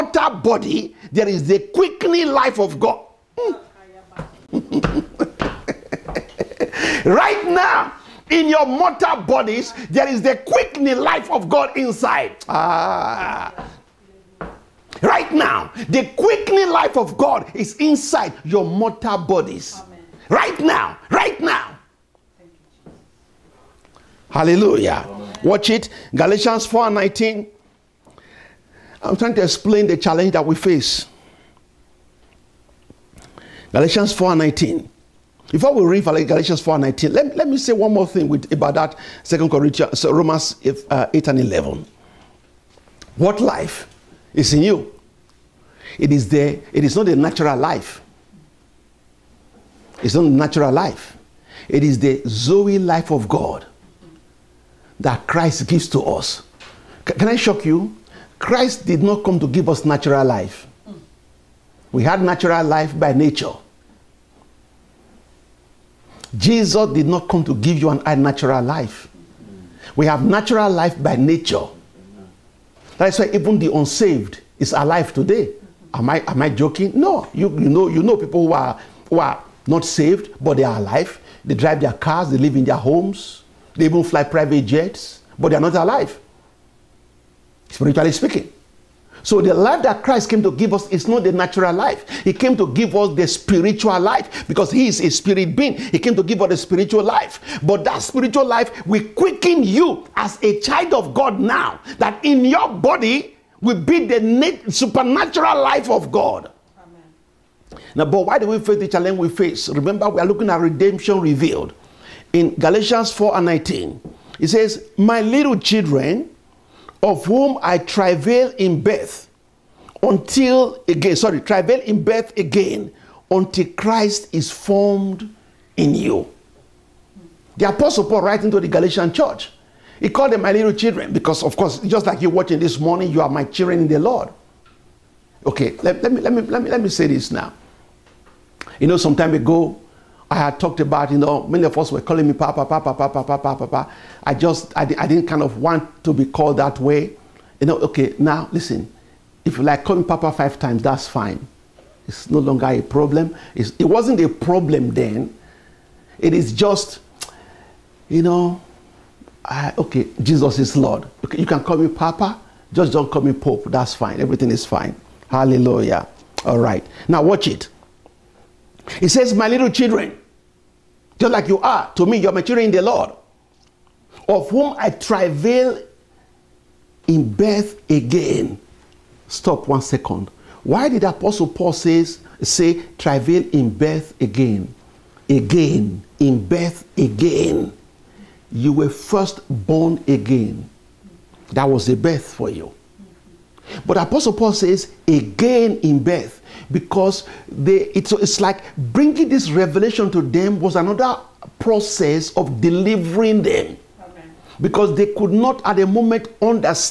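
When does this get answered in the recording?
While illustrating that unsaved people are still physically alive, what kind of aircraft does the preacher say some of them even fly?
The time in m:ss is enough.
1:24.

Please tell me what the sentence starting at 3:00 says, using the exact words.
Why did Apostle Paul says, say, travail in birth again?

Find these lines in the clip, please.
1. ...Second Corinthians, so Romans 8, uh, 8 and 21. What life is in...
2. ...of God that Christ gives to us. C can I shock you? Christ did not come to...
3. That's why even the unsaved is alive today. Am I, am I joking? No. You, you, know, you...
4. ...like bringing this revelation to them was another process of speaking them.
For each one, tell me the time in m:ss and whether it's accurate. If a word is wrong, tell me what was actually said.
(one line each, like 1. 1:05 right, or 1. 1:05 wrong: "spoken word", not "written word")
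1. 0:39 wrong: "11", not "21"
2. 0:53 right
3. 1:12 right
4. 3:18 wrong: "delivering", not "speaking".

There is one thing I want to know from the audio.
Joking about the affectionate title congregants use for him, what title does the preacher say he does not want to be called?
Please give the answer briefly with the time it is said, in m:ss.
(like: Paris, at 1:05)
Pope, at 2:43.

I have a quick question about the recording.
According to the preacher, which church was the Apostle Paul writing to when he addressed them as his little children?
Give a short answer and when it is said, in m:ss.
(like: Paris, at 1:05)
the Galatian church, at 2:08.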